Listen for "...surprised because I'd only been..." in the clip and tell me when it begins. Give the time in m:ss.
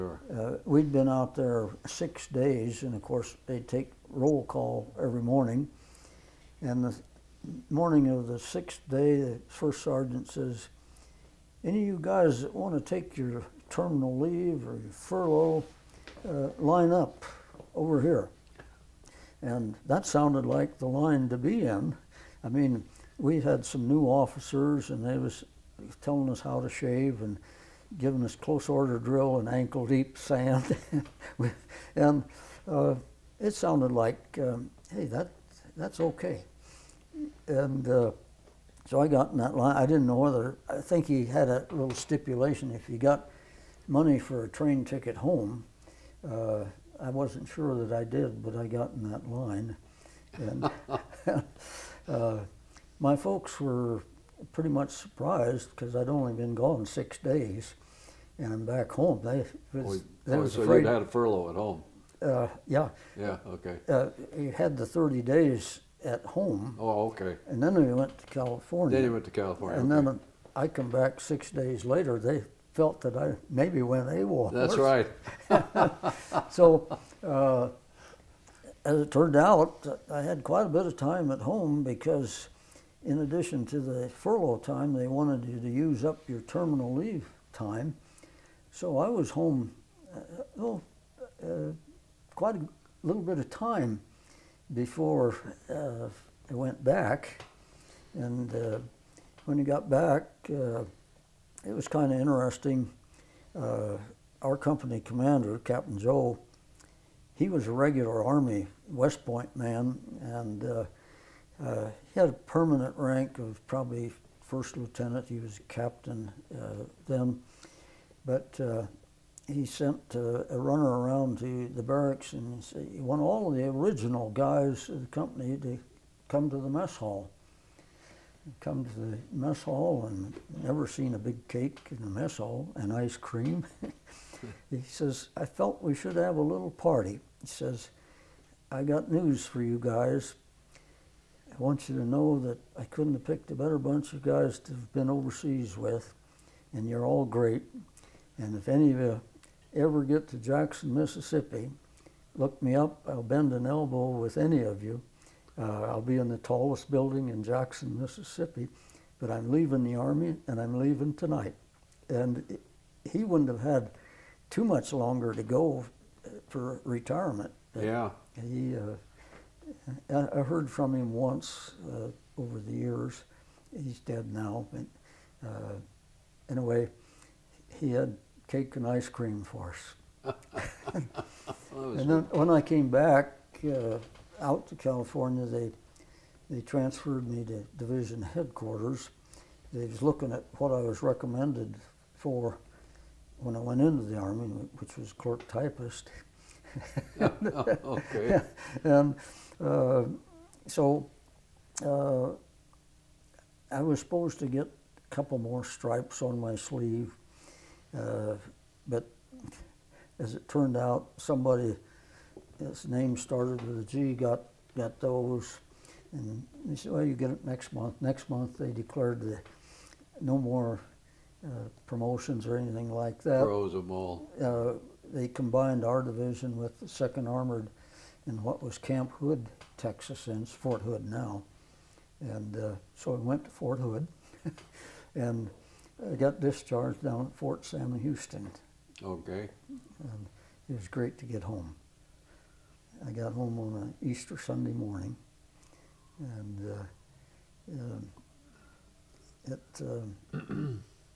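0:54.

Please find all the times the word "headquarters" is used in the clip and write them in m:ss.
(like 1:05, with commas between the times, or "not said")
3:08.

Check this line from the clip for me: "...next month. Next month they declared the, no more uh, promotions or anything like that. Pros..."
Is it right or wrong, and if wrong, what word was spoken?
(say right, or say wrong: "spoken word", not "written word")
right.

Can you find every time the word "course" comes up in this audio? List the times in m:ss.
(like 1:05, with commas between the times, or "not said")
0:03.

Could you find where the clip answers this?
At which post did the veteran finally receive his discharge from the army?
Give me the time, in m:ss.
3:57.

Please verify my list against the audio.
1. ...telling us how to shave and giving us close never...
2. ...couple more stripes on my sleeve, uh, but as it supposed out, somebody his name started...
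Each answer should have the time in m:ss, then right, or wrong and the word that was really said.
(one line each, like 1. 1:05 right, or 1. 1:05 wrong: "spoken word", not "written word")
1. 0:26 wrong: "order", not "never"
2. 3:25 wrong: "turned", not "supposed".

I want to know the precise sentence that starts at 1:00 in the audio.
you had a furlough at home.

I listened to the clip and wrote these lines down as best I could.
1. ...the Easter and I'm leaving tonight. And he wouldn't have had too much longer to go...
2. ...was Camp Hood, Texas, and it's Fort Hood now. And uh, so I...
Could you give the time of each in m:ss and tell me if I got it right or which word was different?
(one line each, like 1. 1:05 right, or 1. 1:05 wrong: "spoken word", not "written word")
1. 2:39 wrong: "Army", not "Easter"
2. 3:48 right.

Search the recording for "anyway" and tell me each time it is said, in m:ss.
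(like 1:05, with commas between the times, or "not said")
2:56.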